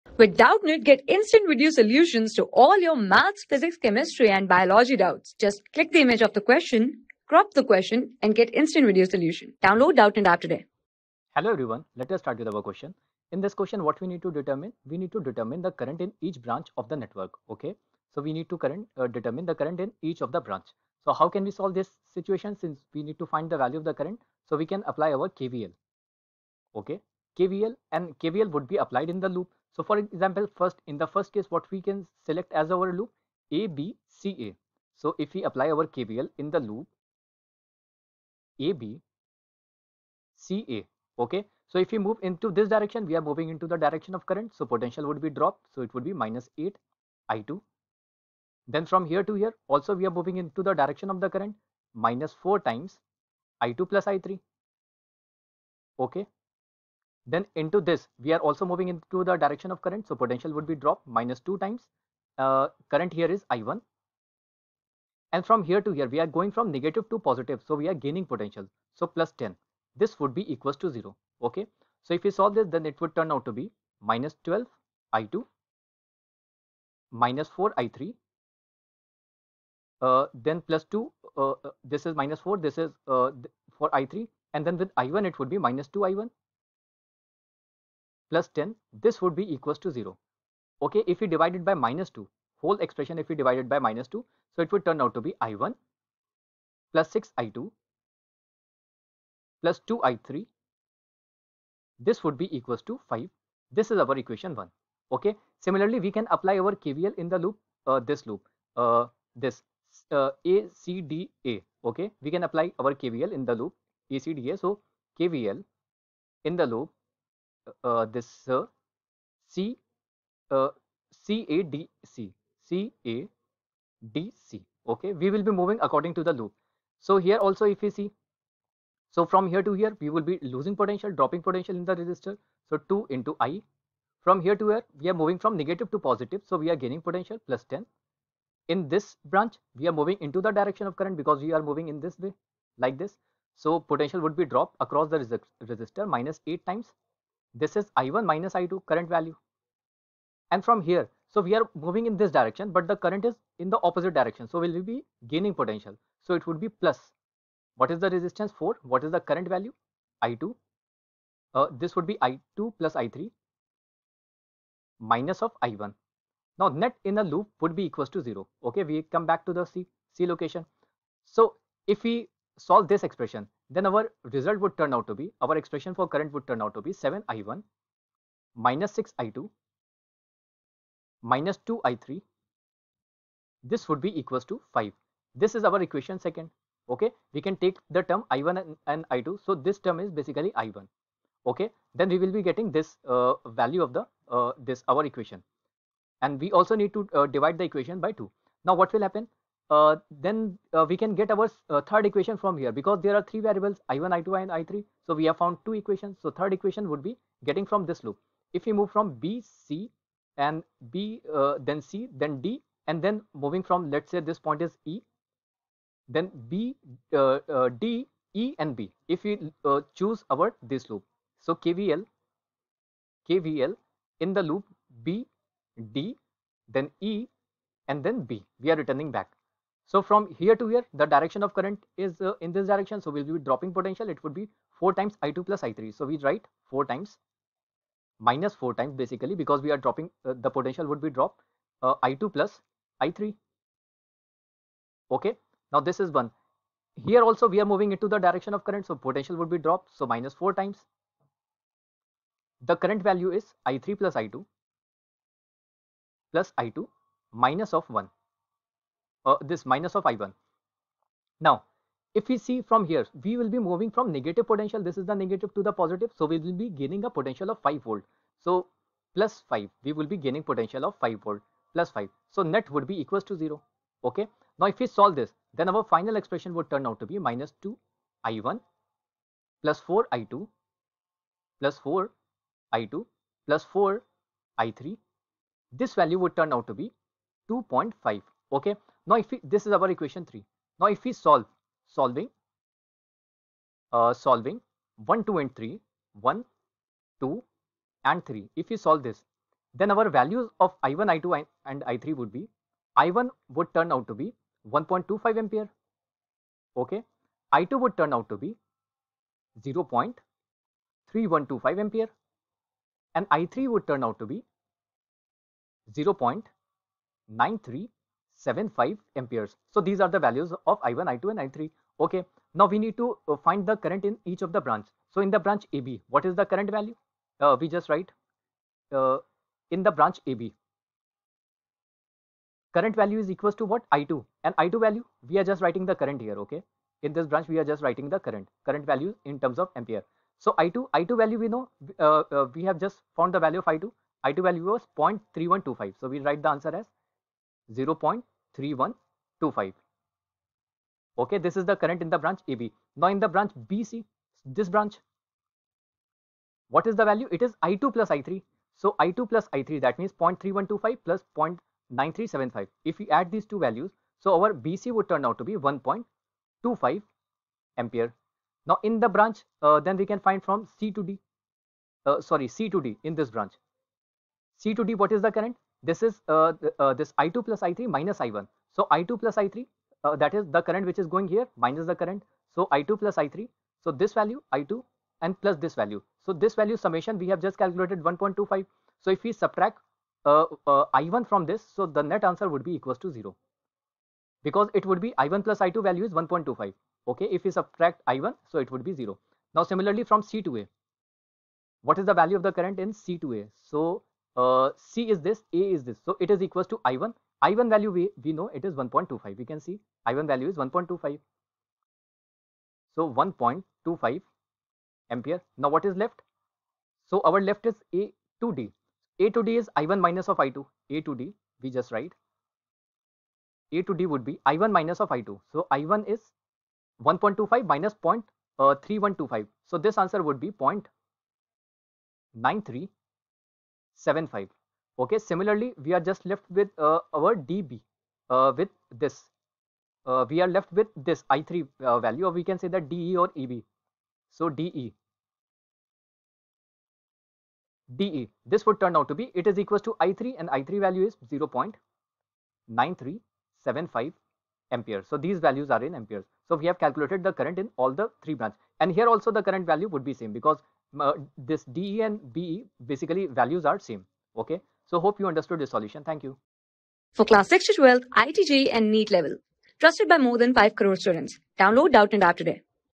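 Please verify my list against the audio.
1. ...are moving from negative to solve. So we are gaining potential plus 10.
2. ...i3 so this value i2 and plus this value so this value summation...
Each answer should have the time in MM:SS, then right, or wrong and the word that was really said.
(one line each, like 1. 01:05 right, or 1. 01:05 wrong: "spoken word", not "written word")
1. 02:15 wrong: "positive", not "solve"
2. 06:23 right.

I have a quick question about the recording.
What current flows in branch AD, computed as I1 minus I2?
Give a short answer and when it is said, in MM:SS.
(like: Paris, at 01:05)
0.9375, at 07:10.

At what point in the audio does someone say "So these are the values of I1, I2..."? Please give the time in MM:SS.
05:19.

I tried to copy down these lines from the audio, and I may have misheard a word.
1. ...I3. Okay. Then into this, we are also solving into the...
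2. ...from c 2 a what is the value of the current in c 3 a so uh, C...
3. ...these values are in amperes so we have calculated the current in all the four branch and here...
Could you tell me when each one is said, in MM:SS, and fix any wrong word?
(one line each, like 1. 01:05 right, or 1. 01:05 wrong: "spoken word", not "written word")
1. 00:54 wrong: "moving", not "solving"
2. 06:40 wrong: "2", not "3"
3. 07:35 wrong: "three", not "four".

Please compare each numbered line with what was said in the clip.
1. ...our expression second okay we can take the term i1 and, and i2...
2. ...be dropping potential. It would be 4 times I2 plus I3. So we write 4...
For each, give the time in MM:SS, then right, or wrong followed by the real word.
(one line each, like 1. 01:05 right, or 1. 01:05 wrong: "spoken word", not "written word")
1. 03:05 wrong: "equation", not "expression"
2. 03:53 right.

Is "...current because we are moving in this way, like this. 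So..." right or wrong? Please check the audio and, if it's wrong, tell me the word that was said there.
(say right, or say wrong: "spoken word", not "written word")
right.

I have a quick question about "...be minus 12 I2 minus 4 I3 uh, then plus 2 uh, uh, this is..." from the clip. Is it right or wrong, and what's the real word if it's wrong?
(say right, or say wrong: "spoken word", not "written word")
right.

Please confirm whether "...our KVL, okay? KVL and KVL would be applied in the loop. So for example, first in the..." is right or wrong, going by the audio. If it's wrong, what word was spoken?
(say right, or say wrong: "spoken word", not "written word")
right.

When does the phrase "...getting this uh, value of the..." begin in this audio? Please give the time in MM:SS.
03:12.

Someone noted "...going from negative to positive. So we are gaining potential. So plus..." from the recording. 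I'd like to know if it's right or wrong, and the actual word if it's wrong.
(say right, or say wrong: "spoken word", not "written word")
right.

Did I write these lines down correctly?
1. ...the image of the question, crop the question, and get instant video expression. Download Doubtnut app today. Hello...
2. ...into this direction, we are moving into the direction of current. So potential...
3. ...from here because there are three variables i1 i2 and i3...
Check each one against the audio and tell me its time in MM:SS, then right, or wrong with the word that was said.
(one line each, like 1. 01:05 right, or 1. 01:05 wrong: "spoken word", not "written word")
1. 00:05 wrong: "solution", not "expression"
2. 00:42 right
3. 03:22 right.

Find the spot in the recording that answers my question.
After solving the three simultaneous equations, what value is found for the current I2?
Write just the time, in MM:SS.
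05:09.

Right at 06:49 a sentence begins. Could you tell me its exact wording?
We can see I1 value is 1.25.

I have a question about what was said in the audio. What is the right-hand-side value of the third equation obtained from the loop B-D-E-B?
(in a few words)
2.5.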